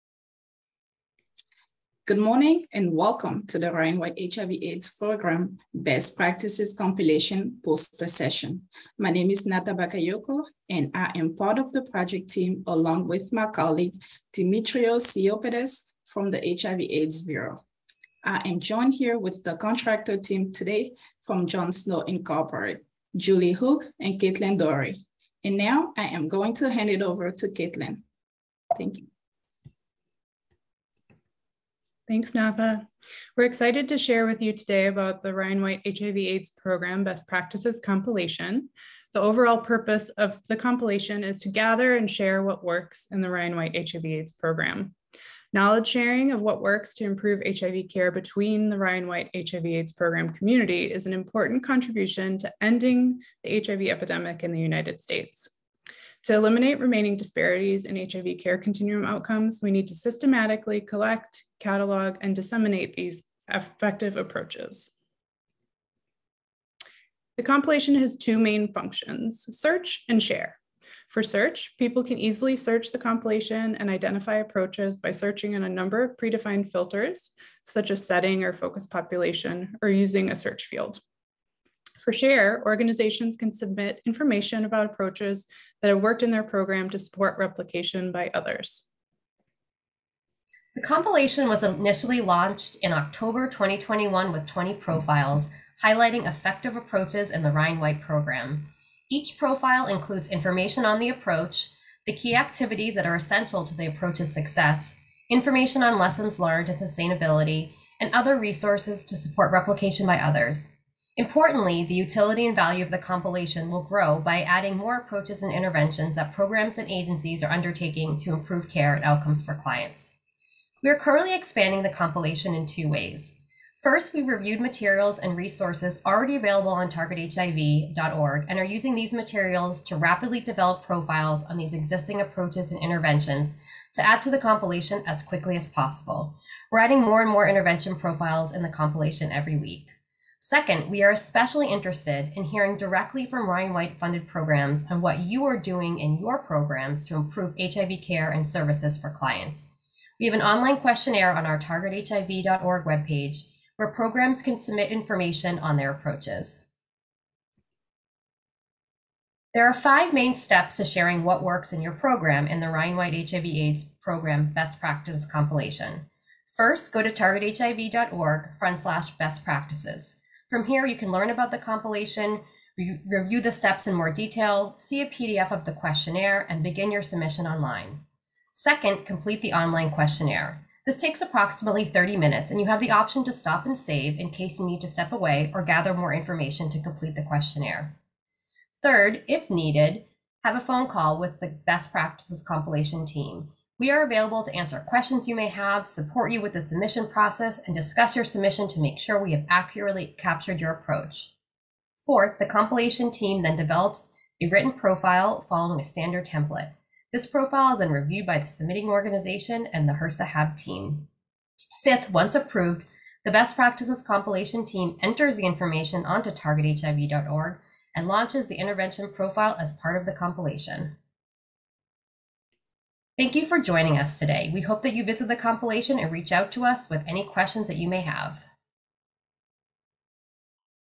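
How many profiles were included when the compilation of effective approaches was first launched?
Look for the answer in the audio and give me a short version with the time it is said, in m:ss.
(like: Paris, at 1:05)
20, at 1:34.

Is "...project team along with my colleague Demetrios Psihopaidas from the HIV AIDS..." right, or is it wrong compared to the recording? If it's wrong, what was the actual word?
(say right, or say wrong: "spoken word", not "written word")
right.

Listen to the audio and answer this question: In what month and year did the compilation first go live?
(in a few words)
October 2021.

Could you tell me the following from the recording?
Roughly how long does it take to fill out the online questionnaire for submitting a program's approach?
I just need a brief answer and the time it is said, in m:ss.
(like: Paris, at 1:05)
30 minutes, at 3:01.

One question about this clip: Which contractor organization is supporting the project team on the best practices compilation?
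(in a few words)
John Snow Incorporated.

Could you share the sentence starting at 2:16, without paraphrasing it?
We're adding more and more intervention profiles in the compilation every week.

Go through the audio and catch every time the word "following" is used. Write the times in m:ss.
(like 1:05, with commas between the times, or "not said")
3:25.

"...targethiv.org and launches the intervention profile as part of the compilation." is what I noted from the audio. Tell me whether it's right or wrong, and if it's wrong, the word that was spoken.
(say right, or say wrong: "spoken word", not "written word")
right.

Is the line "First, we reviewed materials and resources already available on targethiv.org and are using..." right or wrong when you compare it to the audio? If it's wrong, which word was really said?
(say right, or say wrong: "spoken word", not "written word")
right.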